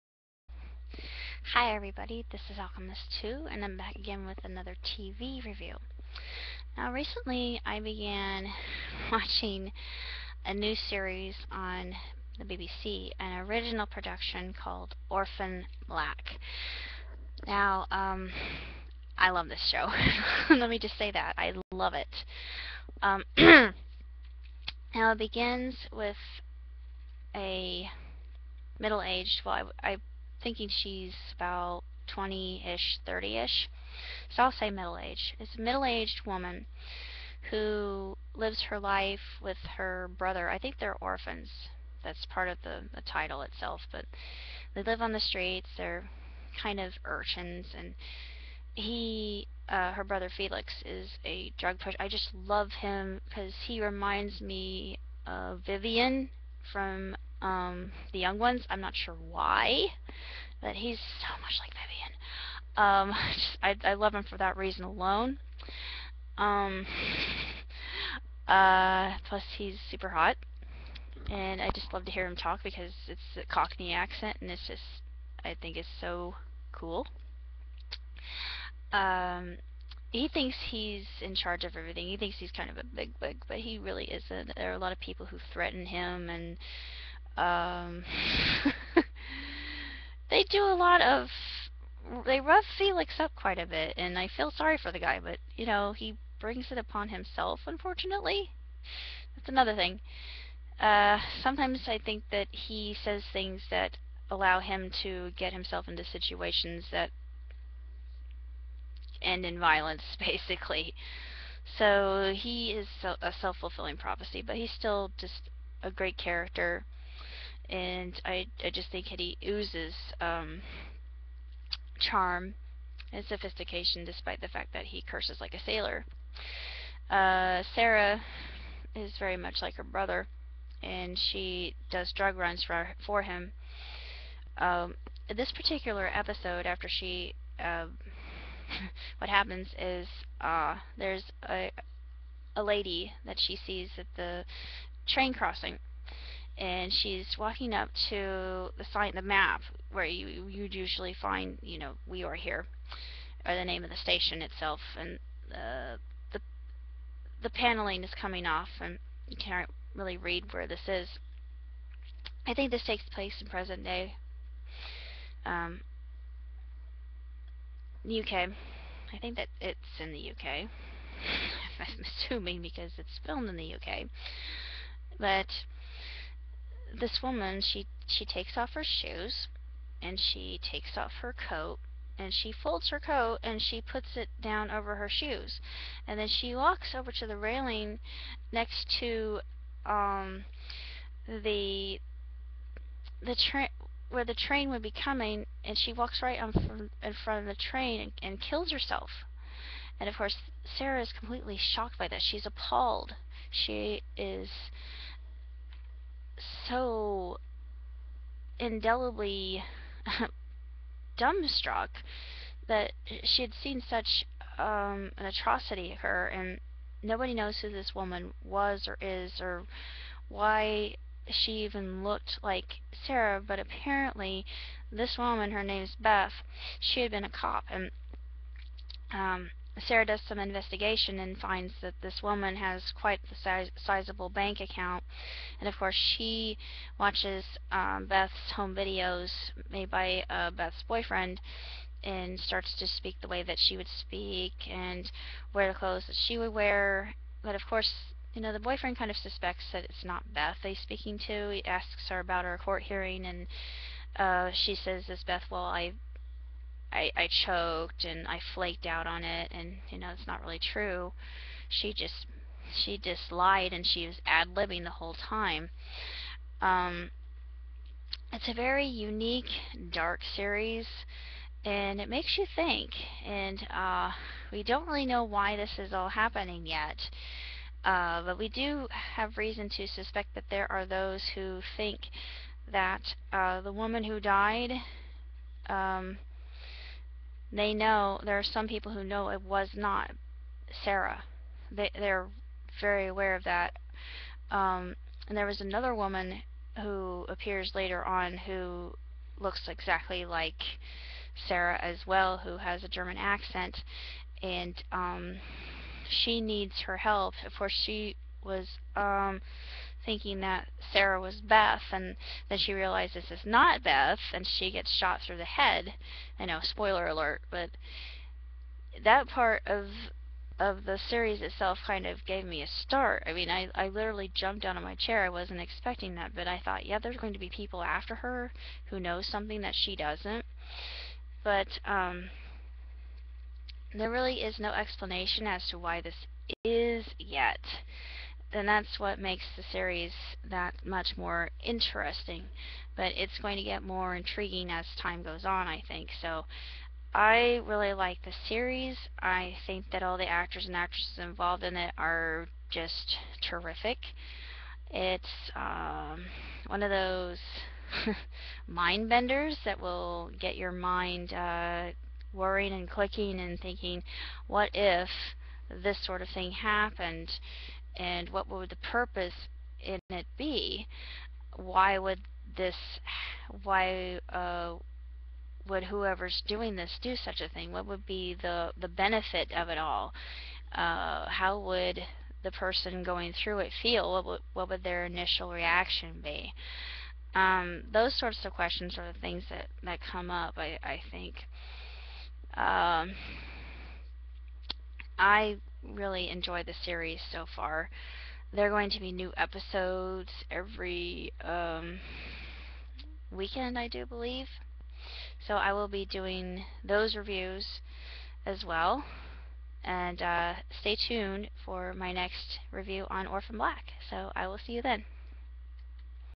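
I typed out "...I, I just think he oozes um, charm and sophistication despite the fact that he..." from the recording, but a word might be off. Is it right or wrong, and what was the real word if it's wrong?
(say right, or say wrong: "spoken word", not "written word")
right.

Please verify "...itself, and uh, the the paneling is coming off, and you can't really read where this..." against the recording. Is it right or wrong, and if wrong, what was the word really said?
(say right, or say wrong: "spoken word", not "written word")
right.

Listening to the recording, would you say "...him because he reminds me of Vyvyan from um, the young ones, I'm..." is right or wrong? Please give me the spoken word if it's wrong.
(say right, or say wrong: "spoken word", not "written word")
right.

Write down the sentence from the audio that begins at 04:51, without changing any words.
They they're very aware of that.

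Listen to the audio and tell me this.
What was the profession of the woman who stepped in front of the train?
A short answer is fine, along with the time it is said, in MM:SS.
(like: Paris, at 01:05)
A cop, at 03:47.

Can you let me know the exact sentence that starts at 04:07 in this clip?
But of course, you know, the boyfriend kind of suspects that it's not Beth he's speaking to.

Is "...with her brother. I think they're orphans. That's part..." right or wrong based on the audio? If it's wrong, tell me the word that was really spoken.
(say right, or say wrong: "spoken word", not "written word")
right.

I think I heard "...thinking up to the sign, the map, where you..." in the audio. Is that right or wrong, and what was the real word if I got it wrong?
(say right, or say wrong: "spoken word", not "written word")
wrong: "walking", not "thinking".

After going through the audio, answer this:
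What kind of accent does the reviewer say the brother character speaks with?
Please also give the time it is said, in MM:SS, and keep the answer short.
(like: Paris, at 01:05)
Cockney, at 01:13.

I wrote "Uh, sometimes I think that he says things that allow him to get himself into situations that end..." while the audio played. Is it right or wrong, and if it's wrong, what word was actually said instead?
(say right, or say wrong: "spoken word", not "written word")
right.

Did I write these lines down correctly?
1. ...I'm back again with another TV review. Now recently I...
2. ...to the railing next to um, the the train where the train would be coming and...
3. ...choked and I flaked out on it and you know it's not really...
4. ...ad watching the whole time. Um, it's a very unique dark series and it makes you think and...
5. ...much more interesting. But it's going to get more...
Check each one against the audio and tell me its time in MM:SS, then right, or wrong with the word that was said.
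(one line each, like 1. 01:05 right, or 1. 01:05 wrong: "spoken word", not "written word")
1. 00:03 right
2. 03:07 right
3. 04:17 right
4. 04:24 wrong: "libbing", not "watching"
5. 05:40 right.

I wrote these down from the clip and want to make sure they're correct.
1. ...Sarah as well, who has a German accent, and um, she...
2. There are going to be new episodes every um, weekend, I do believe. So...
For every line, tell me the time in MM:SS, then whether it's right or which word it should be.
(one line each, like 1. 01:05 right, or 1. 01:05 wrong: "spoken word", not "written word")
1. 05:01 right
2. 06:38 right.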